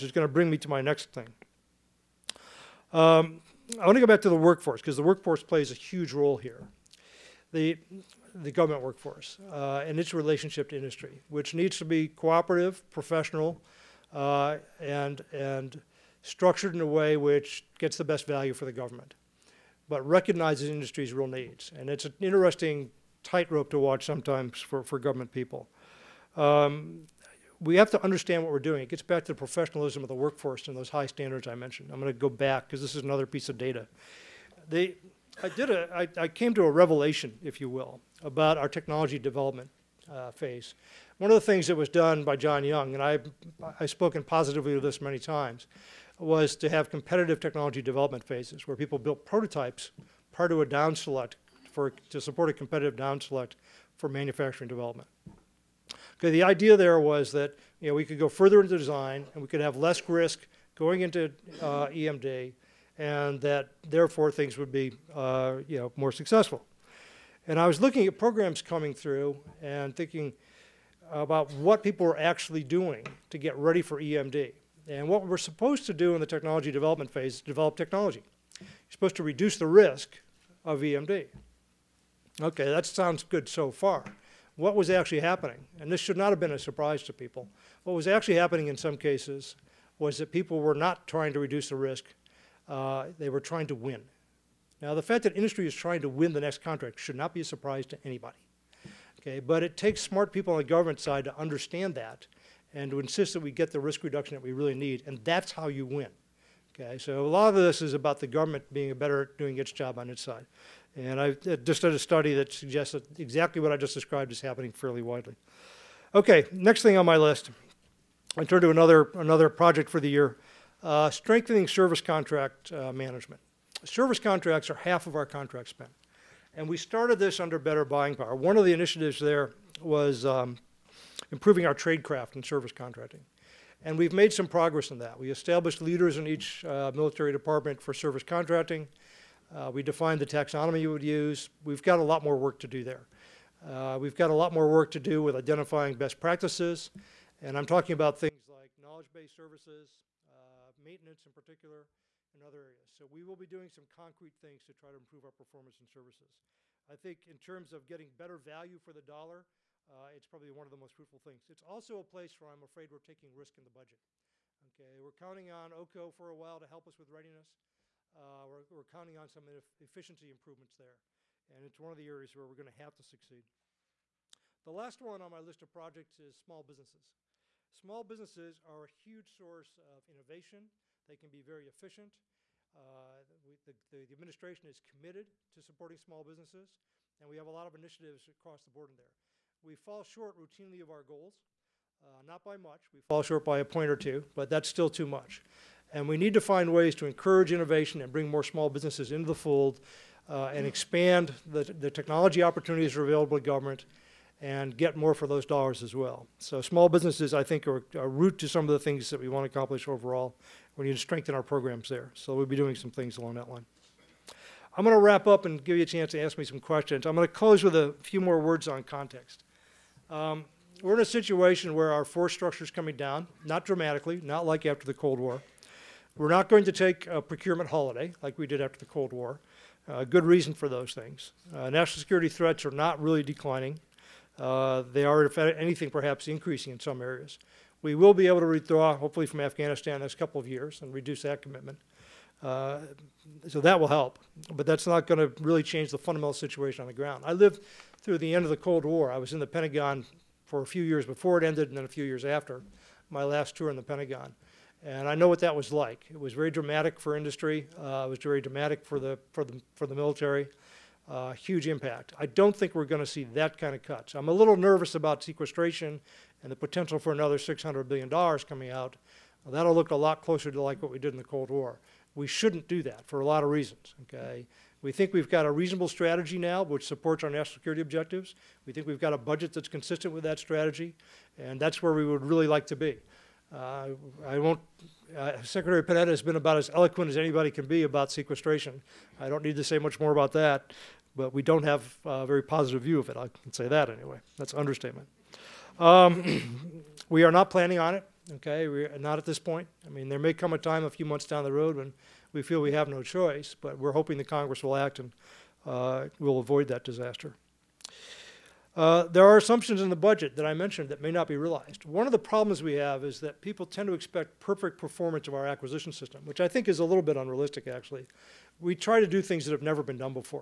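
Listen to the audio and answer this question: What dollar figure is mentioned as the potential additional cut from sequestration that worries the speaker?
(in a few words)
$600 billion.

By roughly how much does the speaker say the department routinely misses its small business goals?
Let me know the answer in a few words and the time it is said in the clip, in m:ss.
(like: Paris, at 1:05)
a point or two, at 3:13.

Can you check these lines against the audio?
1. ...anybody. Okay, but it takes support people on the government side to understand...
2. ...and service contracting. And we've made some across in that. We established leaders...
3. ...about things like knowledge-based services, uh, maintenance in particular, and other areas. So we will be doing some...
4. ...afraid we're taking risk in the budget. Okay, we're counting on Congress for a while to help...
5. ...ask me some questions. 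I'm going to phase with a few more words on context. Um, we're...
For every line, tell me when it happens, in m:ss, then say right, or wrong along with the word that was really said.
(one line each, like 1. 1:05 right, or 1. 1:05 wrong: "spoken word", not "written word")
1. 1:38 wrong: "smart", not "support"
2. 2:12 wrong: "progress", not "across"
3. 2:27 right
4. 2:42 wrong: "OCO", not "Congress"
5. 3:36 wrong: "close", not "phase".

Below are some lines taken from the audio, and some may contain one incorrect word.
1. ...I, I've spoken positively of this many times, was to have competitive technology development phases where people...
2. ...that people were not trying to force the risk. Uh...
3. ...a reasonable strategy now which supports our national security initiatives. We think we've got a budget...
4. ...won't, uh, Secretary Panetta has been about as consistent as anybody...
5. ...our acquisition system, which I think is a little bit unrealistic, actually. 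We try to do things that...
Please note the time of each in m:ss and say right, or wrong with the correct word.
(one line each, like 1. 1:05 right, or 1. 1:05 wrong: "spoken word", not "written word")
1. 0:43 right
2. 1:30 wrong: "reduce", not "force"
3. 4:35 wrong: "objectives", not "initiatives"
4. 4:44 wrong: "eloquent", not "consistent"
5. 5:15 right.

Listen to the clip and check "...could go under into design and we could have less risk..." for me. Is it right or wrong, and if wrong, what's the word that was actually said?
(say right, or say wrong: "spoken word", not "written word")
wrong: "further", not "under".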